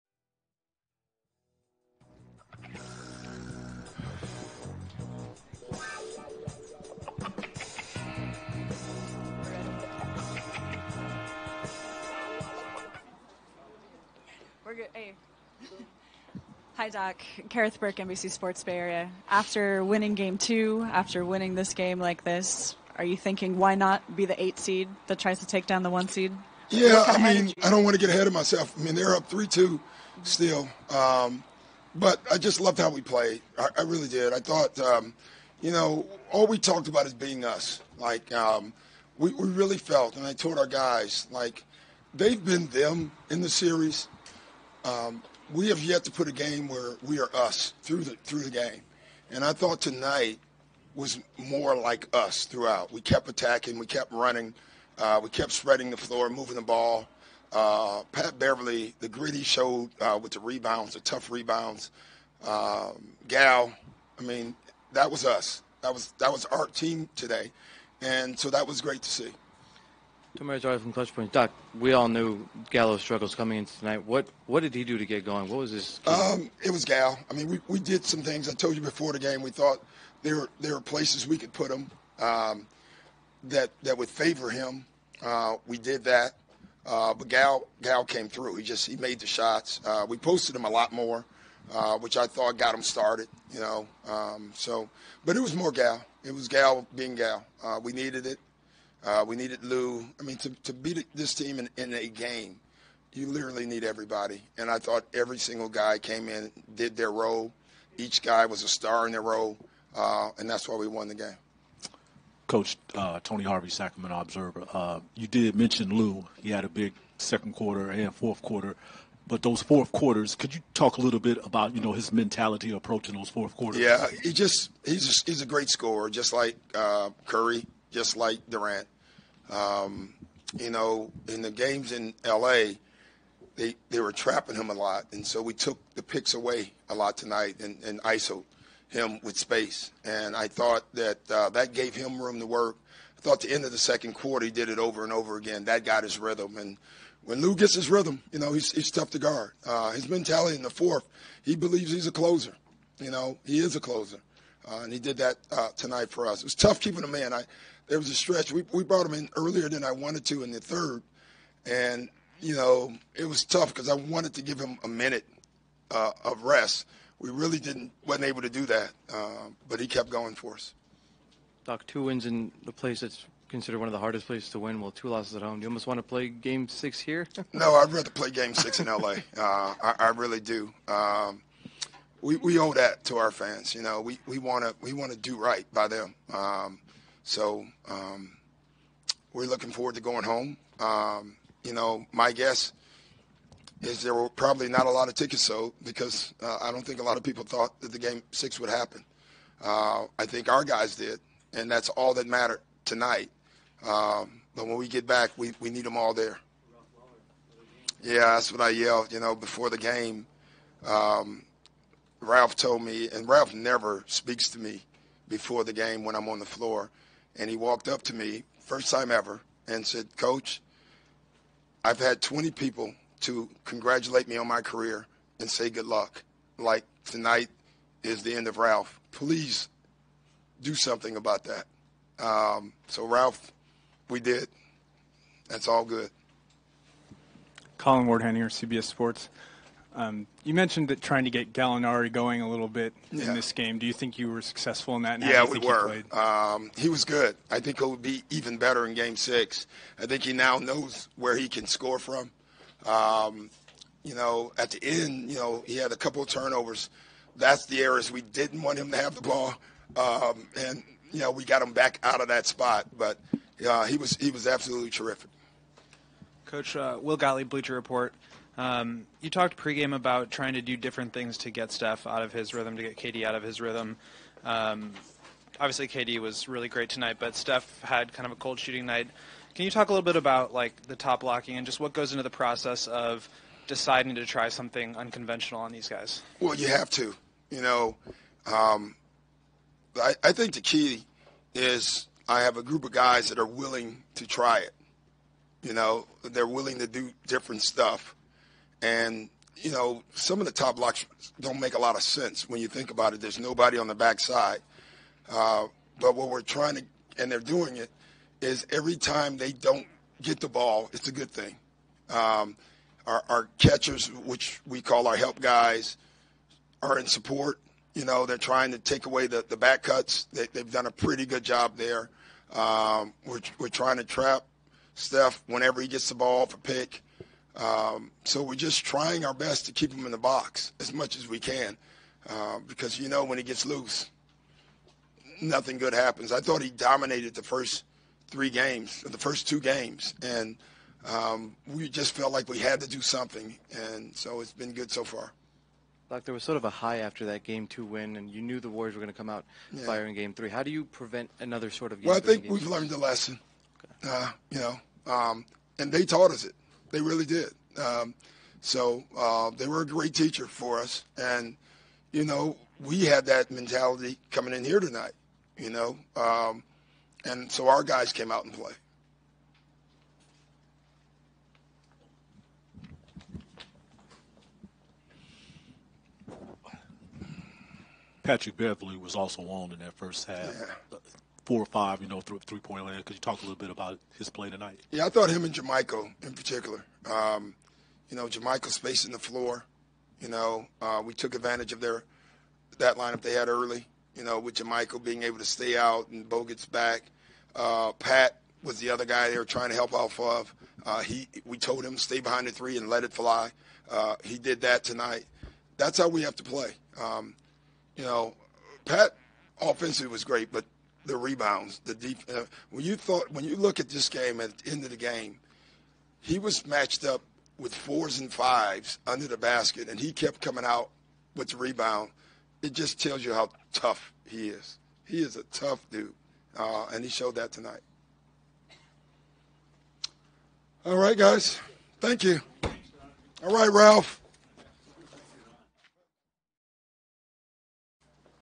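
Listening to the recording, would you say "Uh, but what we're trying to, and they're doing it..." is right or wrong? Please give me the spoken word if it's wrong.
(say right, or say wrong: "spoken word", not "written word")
right.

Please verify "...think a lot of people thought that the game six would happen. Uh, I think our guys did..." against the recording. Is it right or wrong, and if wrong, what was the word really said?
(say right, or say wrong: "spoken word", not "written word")
right.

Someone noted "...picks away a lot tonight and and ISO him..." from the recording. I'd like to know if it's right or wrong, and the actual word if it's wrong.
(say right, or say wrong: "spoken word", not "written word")
right.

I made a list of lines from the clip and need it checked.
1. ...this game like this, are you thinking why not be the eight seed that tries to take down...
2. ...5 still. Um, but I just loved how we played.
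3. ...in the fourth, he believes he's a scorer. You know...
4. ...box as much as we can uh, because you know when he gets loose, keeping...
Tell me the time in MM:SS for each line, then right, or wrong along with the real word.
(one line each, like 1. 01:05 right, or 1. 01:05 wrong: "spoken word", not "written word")
1. 00:21 right
2. 00:29 wrong: "2", not "5"
3. 02:30 wrong: "closer", not "scorer"
4. 05:30 wrong: "nothing", not "keeping".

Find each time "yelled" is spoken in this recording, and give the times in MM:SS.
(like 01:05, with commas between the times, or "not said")
03:28.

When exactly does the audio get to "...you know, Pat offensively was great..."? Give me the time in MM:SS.
06:47.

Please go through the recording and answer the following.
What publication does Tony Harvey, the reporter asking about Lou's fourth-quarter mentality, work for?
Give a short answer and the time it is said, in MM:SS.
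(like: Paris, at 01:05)
Sacramento Observer, at 01:53.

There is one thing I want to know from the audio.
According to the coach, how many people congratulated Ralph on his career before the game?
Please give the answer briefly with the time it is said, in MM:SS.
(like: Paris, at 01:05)
20, at 03:42.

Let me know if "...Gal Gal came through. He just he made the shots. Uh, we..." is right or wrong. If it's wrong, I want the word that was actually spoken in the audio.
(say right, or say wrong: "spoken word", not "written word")
right.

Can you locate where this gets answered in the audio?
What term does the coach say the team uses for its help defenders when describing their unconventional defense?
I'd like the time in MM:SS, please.
05:13.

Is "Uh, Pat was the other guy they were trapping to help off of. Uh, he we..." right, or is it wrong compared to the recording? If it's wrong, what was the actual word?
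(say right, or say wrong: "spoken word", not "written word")
wrong: "trying", not "trapping".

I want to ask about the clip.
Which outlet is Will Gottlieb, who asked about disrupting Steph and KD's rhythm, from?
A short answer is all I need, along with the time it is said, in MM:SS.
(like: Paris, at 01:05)
Bleacher Report, at 04:27.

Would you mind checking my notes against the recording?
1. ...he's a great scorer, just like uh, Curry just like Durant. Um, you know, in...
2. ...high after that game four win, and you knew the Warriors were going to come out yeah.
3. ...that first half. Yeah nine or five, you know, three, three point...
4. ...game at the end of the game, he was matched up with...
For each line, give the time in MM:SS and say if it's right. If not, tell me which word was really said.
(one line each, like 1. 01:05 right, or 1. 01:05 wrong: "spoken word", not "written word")
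1. 02:05 right
2. 05:46 wrong: "two", not "four"
3. 06:19 wrong: "four", not "nine"
4. 06:54 right.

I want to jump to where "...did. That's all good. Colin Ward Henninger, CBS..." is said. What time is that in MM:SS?
03:54.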